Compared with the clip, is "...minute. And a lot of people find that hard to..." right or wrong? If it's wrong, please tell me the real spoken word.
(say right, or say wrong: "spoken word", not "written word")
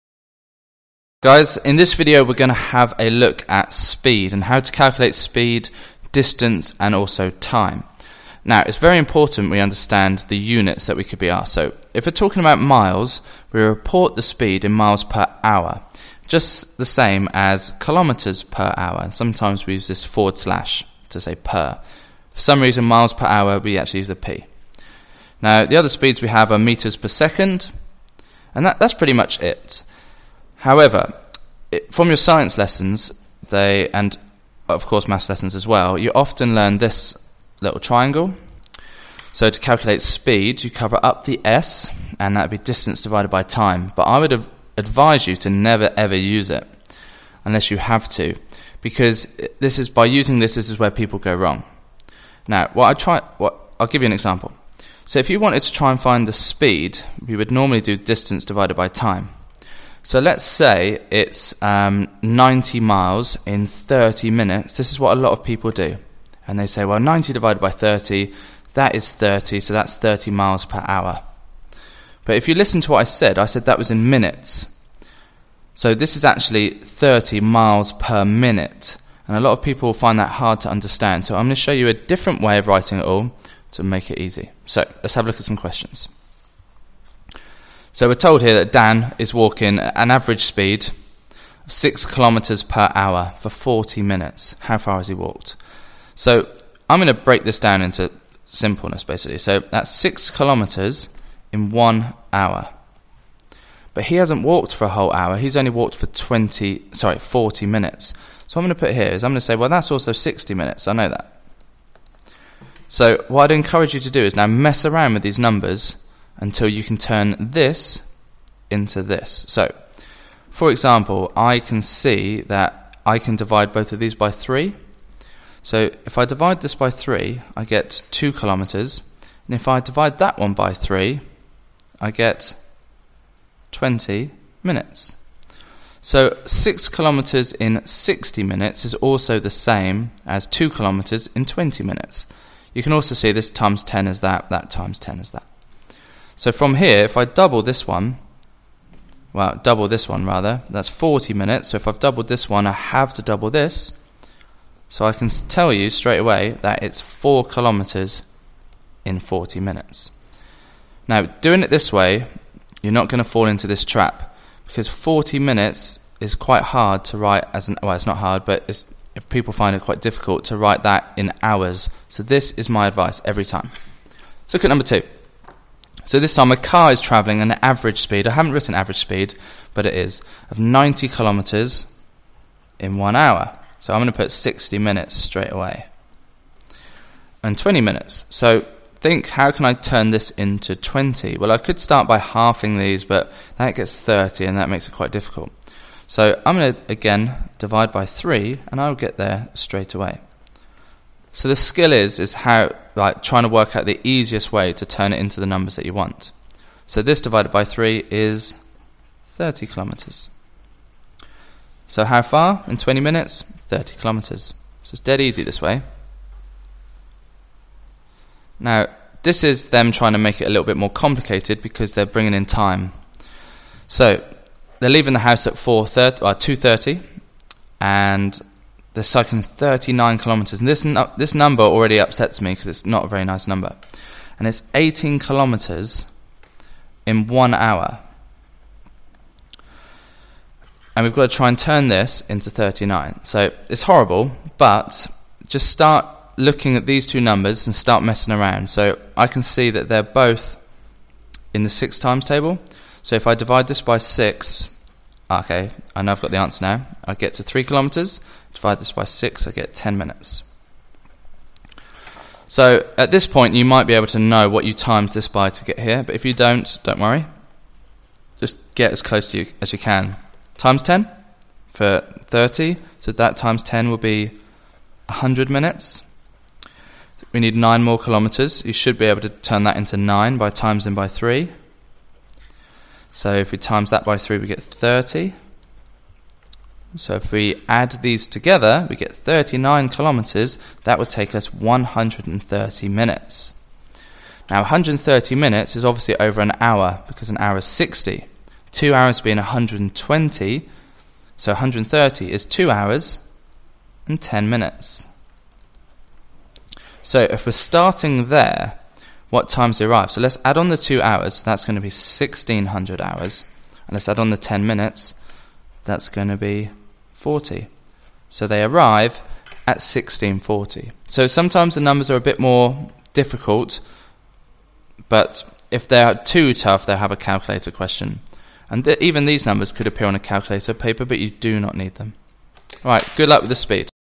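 right.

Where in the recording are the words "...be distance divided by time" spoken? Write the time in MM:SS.
00:42.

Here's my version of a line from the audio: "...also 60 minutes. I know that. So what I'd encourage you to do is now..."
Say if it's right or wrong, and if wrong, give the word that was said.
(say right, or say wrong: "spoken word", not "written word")
right.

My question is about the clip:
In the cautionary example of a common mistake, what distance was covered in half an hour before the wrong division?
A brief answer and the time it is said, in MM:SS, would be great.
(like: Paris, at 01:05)
90 miles, at 01:02.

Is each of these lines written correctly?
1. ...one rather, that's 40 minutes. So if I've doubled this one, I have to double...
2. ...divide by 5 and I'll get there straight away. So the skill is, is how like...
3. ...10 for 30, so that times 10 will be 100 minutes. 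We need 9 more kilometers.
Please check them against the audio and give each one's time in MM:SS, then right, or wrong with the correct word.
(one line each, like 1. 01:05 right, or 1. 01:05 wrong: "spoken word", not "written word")
1. 02:30 right
2. 03:17 wrong: "3", not "5"
3. 04:30 right.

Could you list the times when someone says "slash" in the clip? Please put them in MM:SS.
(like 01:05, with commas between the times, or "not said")
00:20.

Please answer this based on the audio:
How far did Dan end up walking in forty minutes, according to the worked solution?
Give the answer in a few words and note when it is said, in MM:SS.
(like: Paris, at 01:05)
4 kilometres, at 02:36.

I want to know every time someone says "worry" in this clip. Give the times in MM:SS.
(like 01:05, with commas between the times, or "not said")
04:26.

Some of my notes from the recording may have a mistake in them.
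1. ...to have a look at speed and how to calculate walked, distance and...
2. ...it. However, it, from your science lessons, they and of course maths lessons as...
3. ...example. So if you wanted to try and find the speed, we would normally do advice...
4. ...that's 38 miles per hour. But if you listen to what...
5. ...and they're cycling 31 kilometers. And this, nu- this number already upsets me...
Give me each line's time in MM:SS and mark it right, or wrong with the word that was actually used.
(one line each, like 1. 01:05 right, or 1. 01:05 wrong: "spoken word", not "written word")
1. 00:02 wrong: "speed", not "walked"
2. 00:29 right
3. 00:54 wrong: "distance", not "advice"
4. 01:09 wrong: "30", not "38"
5. 03:47 wrong: "39", not "31".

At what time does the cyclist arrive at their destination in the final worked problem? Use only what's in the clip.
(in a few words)
16:40.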